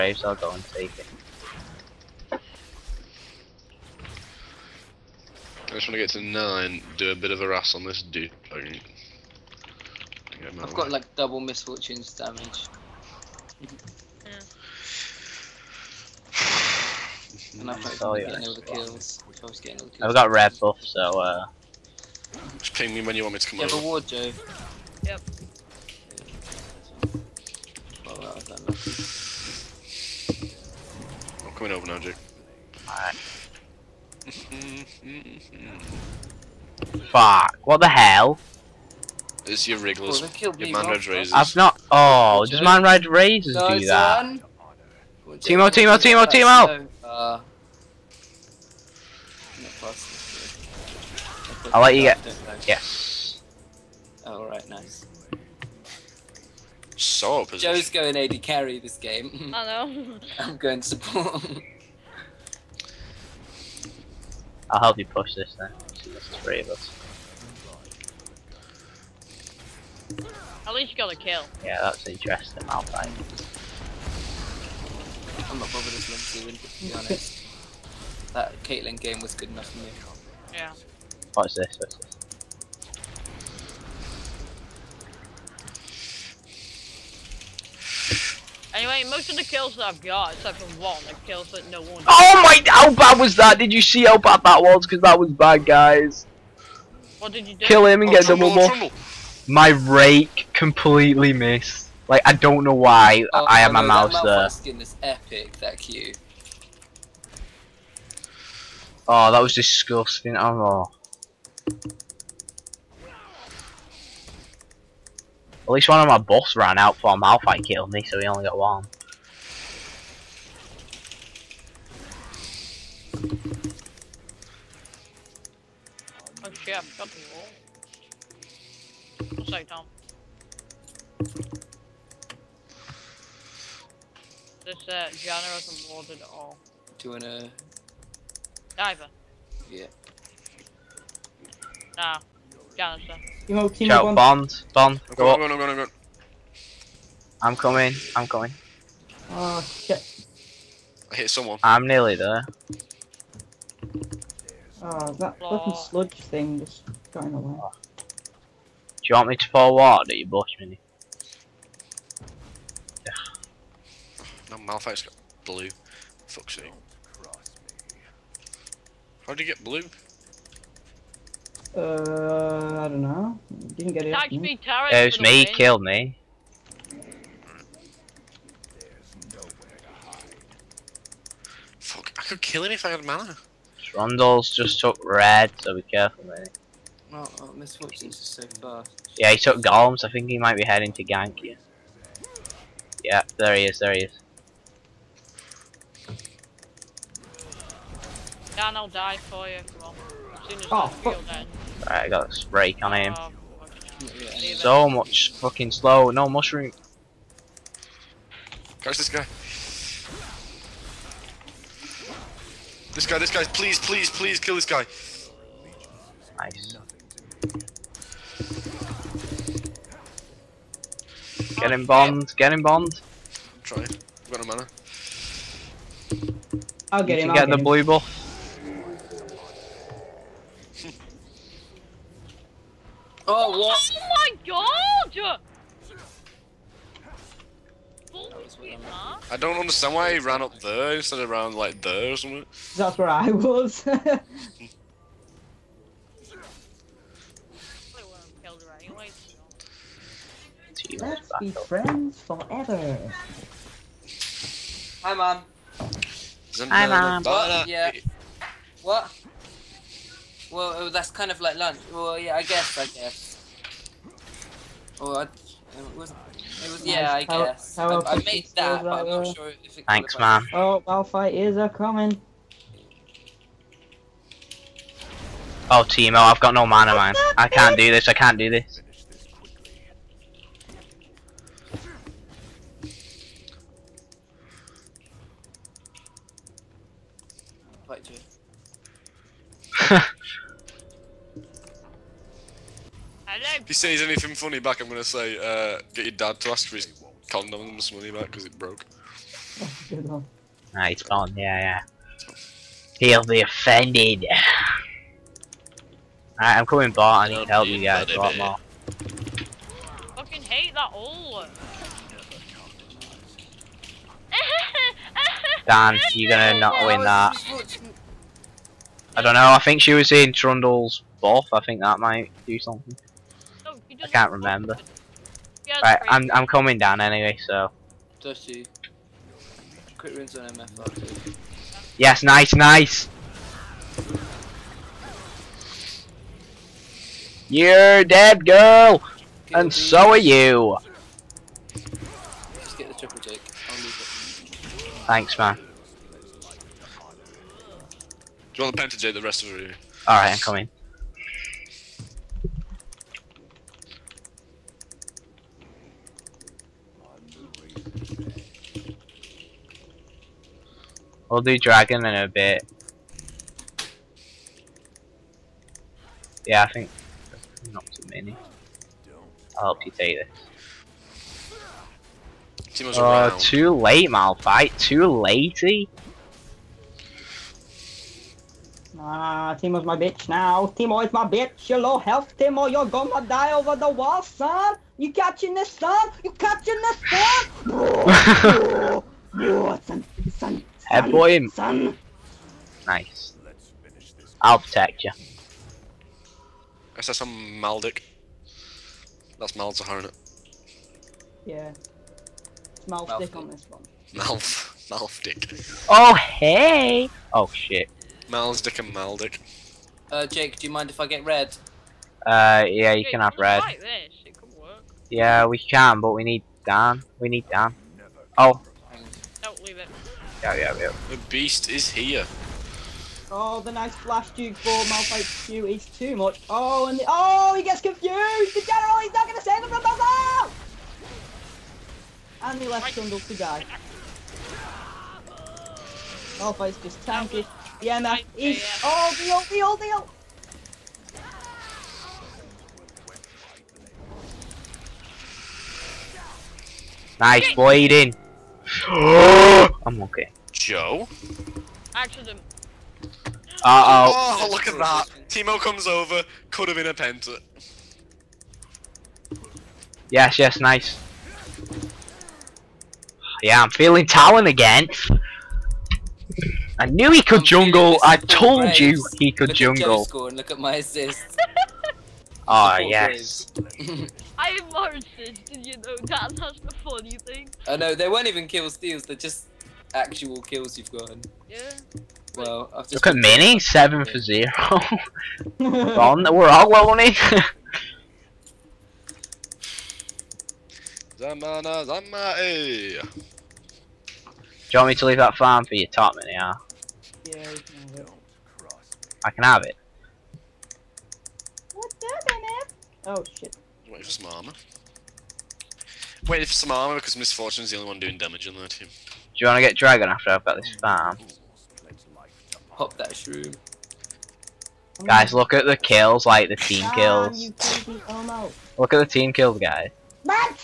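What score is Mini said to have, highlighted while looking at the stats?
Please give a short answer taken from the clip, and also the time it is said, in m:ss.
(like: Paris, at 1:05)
7 for 0, at 8:03.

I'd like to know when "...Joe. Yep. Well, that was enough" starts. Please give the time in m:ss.
0:24.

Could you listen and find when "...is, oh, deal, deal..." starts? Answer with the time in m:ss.
7:18.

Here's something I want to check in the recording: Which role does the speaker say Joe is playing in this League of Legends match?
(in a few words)
AD carry.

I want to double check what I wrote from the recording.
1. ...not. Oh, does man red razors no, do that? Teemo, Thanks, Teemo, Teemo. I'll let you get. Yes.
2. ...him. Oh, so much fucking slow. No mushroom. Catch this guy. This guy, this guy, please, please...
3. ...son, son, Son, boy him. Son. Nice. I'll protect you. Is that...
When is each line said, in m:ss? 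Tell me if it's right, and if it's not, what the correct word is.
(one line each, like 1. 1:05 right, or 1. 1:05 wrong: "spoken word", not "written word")
1. 0:41 wrong: "Teemo", not "Thanks"
2. 3:22 right
3. 6:29 right.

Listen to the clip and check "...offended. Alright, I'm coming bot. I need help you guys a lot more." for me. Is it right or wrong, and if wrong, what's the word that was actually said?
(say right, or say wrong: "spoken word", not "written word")
right.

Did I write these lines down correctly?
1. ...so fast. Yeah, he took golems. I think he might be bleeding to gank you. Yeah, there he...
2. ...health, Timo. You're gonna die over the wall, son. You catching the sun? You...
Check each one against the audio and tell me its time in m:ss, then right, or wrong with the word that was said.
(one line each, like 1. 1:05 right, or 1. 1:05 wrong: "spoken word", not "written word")
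1. 3:08 wrong: "heading", not "bleeding"
2. 6:21 right.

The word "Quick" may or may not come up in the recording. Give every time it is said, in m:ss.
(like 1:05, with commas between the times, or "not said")
5:29.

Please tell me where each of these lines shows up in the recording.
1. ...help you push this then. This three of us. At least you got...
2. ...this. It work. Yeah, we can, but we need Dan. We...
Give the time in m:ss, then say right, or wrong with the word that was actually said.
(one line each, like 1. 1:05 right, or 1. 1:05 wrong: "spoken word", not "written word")
1. 1:04 right
2. 6:53 right.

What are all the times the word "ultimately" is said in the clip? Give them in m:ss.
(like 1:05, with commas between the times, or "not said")
not said.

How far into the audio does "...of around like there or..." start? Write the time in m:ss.
4:01.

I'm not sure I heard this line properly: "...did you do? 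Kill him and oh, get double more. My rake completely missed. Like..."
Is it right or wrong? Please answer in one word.
right.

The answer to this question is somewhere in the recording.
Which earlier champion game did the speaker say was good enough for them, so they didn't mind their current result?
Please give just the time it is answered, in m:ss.
1:18.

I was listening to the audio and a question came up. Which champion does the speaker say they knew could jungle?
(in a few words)
Talon.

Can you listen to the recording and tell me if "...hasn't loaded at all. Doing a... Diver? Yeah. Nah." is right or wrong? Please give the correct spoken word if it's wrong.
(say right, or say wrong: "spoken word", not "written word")
right.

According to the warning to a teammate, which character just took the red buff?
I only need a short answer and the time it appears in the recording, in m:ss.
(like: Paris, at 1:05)
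Rondol, at 3:03.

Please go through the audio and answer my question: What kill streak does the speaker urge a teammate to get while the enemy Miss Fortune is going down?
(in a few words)
triple take.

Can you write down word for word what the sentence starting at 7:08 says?
The general, he's not going to save him from Bazaar!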